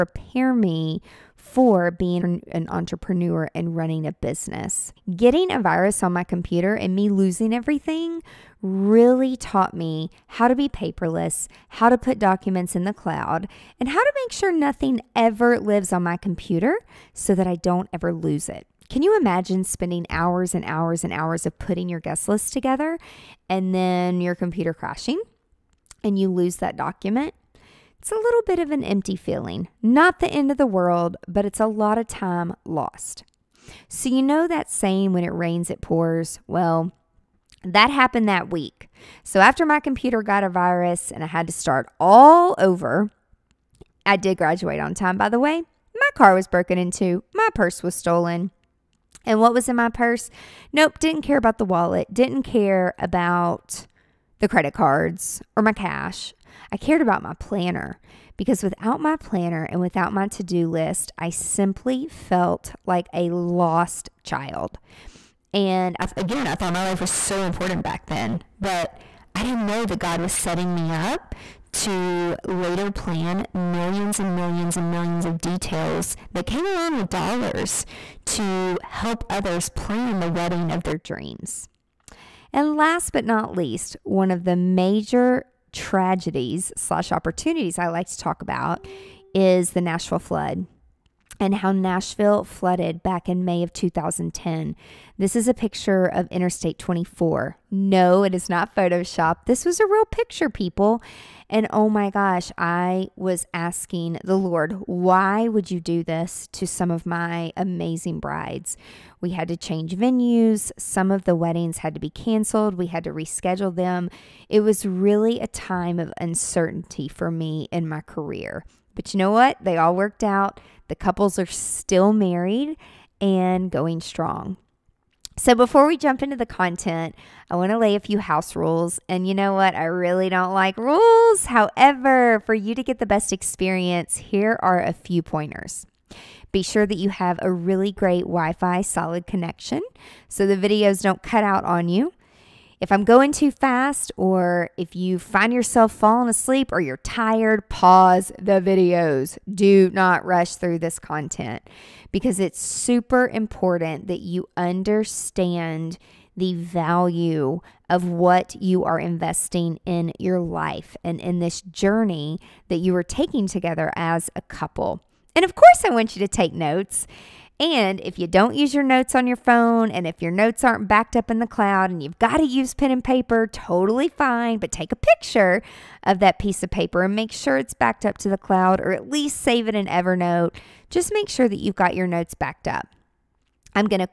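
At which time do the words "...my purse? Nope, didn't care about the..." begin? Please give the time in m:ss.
0:49.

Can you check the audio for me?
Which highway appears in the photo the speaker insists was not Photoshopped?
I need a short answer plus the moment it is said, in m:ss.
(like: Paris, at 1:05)
Interstate 24, at 1:36.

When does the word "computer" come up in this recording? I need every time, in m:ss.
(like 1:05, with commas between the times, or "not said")
0:06, 0:16, 0:24, 0:39.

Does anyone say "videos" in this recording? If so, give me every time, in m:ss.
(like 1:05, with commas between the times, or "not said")
2:20, 2:28.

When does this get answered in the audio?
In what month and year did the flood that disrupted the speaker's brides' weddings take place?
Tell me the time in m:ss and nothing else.
1:33.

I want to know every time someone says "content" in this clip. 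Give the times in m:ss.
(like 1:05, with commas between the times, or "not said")
2:06, 2:31.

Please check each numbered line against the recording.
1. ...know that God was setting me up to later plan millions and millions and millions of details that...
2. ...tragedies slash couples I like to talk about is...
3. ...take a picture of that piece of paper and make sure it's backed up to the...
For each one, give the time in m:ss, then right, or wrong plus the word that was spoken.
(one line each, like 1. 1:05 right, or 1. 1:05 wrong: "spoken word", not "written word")
1. 1:09 right
2. 1:25 wrong: "opportunities", not "couples"
3. 2:54 right.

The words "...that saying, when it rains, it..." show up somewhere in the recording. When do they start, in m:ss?
0:34.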